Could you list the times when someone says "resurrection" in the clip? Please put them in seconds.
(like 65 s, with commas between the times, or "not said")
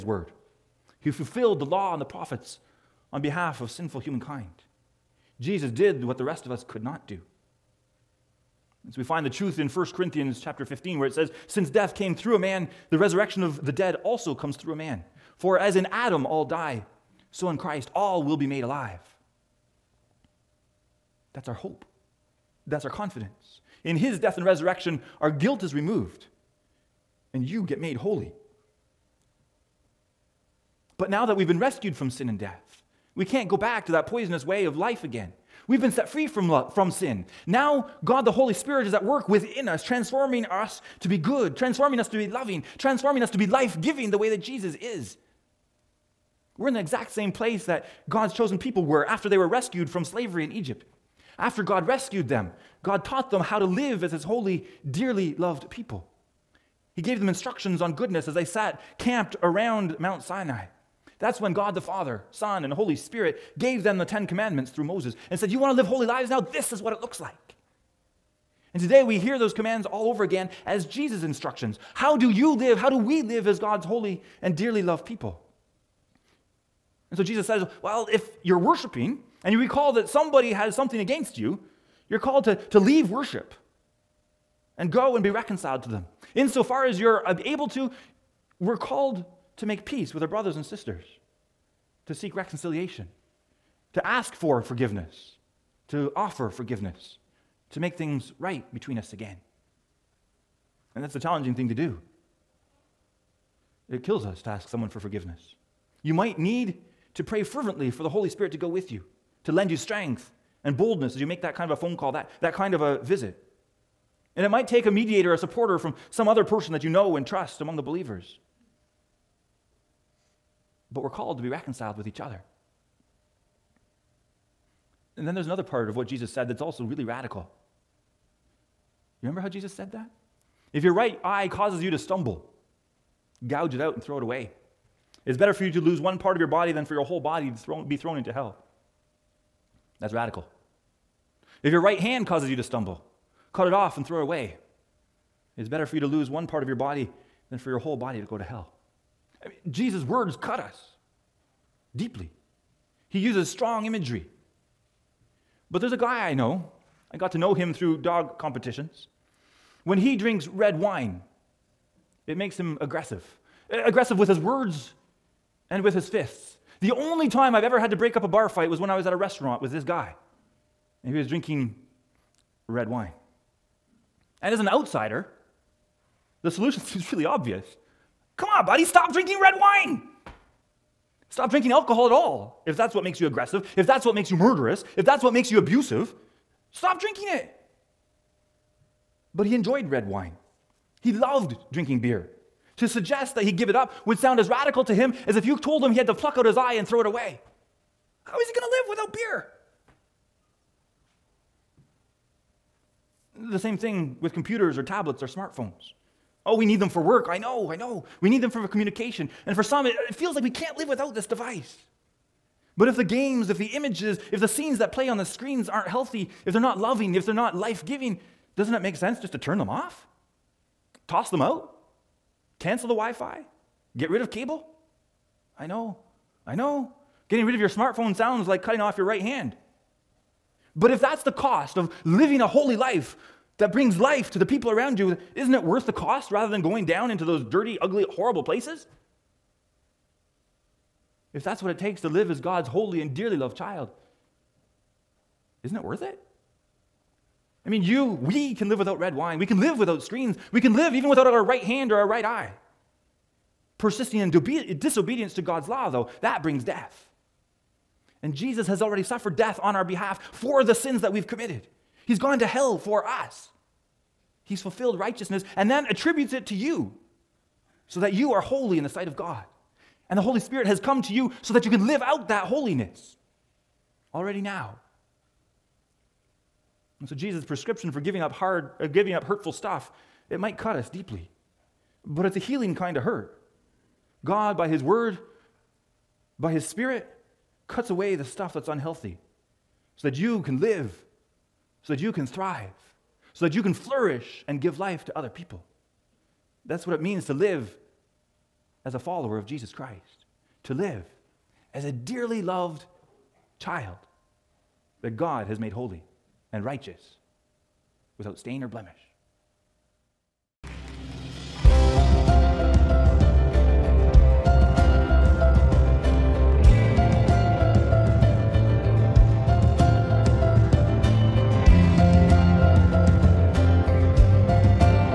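12 s, 24 s.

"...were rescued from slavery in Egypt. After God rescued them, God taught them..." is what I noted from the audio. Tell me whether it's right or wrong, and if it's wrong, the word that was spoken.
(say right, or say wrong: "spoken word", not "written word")
right.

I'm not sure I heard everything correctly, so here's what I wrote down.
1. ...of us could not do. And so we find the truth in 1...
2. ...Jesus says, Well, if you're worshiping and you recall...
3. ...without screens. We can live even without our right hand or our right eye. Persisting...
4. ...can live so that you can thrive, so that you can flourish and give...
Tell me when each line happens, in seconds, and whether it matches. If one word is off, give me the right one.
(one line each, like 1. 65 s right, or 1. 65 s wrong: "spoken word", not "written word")
1. 6 s right
2. 77 s right
3. 249 s right
4. 290 s right.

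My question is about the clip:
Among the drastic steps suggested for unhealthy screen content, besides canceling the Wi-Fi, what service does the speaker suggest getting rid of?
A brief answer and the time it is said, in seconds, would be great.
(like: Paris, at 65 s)
Cable, at 224 s.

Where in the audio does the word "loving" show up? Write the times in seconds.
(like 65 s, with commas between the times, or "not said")
42 s, 216 s.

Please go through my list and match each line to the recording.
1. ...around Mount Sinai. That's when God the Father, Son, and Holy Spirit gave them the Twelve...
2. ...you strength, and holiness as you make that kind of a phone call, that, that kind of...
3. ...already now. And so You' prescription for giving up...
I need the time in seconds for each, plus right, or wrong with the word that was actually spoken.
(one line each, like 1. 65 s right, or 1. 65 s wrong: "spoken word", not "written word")
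1. 59 s wrong: "Ten", not "Twelve"
2. 109 s wrong: "boldness", not "holiness"
3. 274 s wrong: "Jesus", not "You".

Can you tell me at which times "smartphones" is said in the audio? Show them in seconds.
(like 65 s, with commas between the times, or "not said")
205 s, 227 s.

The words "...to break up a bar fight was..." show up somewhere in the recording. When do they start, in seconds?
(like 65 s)
167 s.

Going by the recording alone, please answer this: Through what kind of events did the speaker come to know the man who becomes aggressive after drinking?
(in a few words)
Dog competitions.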